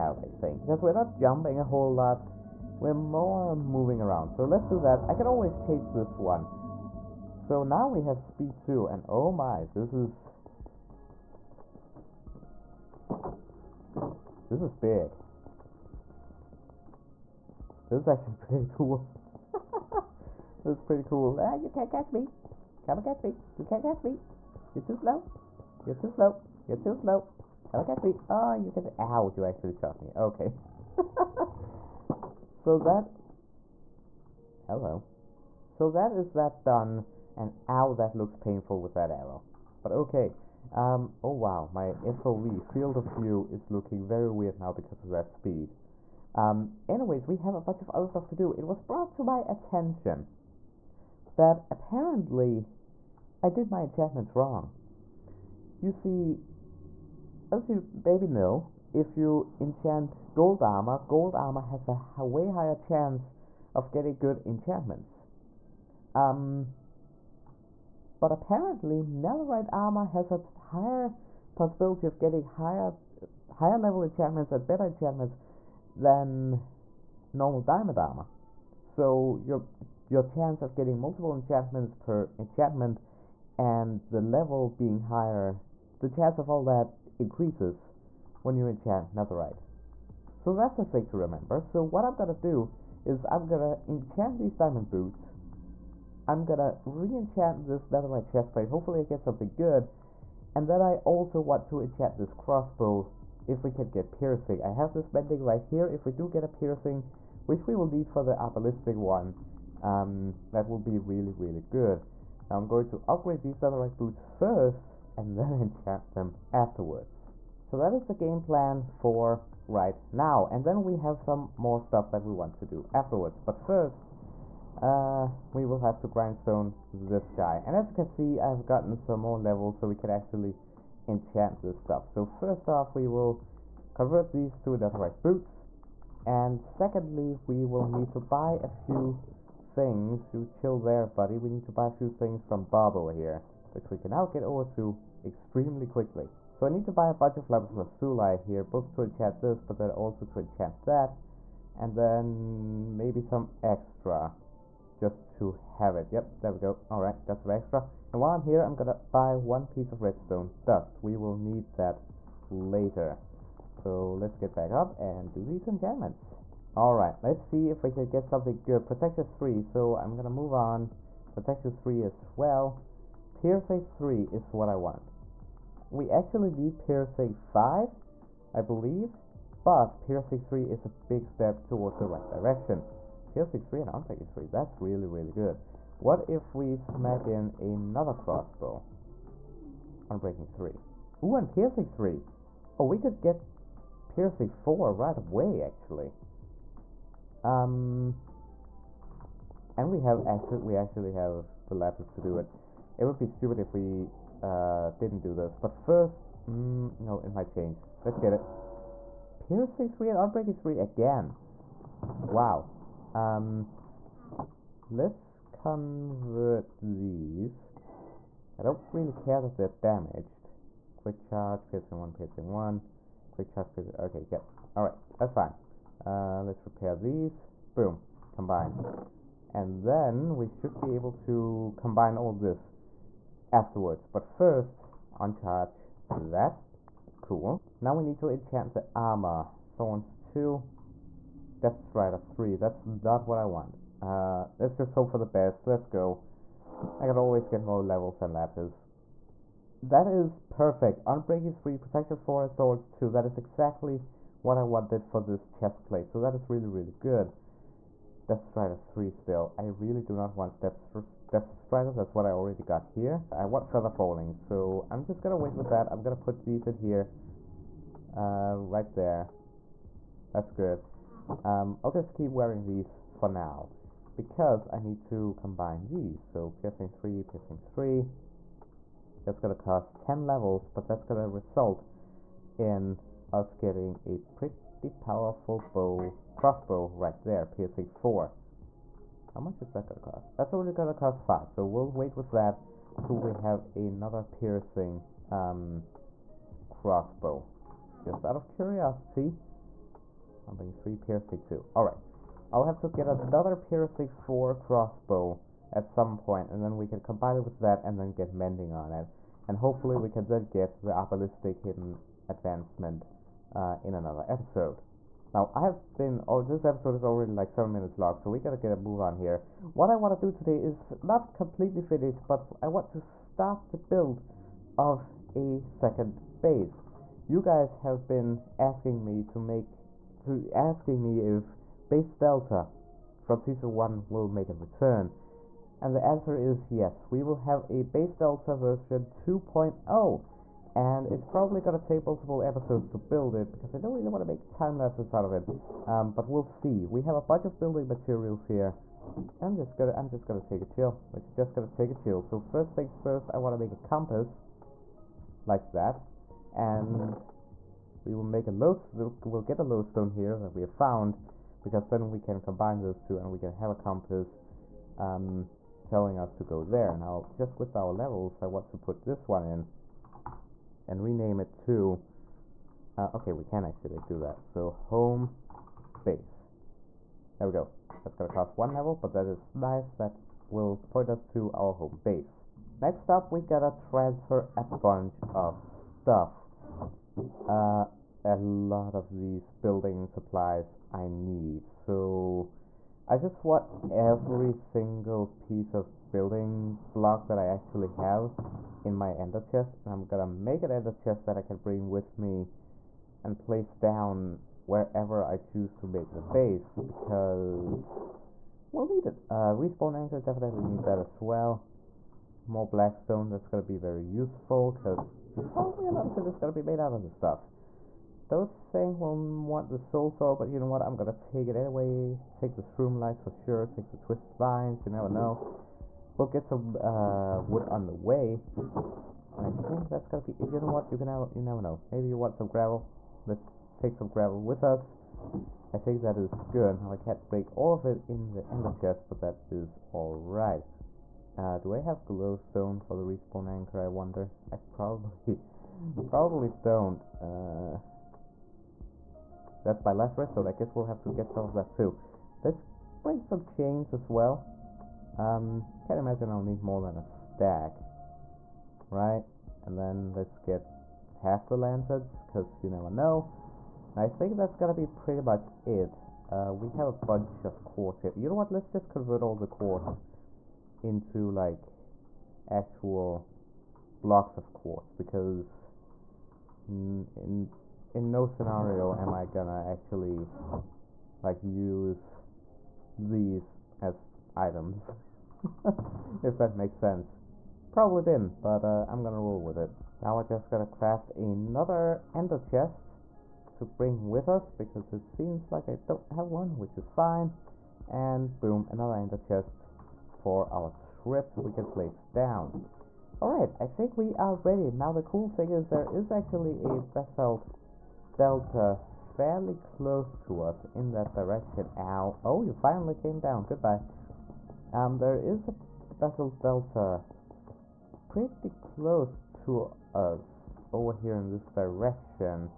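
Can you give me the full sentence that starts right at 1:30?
So that's a thing to remember.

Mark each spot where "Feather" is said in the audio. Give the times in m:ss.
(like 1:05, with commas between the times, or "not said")
4:23.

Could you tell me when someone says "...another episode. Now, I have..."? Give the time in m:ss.
5:13.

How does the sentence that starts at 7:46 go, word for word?
Uh, we have a bunch of quartz here.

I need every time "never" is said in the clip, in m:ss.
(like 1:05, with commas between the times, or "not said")
7:04, 7:11, 7:42.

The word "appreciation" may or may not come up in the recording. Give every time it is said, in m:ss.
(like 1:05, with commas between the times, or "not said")
not said.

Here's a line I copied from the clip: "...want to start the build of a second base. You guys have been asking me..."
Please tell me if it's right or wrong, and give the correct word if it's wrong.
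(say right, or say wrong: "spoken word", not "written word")
right.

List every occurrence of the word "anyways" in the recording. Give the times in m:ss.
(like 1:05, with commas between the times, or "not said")
0:46, 7:01.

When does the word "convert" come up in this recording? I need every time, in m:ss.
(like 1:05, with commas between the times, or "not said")
2:13, 3:35, 7:48.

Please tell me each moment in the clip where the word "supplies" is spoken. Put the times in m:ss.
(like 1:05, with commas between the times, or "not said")
6:30.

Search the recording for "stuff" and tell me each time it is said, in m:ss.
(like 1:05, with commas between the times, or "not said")
0:48, 2:01, 2:11, 6:25, 6:57.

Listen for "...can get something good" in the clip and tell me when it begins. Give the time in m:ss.
2:47.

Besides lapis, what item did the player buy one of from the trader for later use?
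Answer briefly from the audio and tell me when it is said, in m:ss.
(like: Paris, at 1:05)
Redstone dust, at 2:40.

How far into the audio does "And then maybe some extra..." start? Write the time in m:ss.
2:31.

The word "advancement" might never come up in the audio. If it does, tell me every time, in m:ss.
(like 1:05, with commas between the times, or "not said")
5:12.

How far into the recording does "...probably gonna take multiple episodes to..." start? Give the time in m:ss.
5:41.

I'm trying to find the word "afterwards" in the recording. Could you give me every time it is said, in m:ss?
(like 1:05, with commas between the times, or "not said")
1:56, 2:02, 3:53.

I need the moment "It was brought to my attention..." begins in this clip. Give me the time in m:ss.
0:48.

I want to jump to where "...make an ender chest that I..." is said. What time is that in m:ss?
6:40.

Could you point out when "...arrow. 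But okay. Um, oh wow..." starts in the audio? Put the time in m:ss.
0:39.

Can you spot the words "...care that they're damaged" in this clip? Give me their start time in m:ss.
3:39.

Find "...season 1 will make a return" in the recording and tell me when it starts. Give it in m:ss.
5:33.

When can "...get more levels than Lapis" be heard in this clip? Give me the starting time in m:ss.
4:07.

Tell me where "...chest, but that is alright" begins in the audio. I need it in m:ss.
7:18.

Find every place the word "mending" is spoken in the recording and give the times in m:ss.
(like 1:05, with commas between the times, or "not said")
1:45, 5:08.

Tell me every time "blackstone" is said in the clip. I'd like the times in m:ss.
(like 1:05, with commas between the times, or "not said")
6:52.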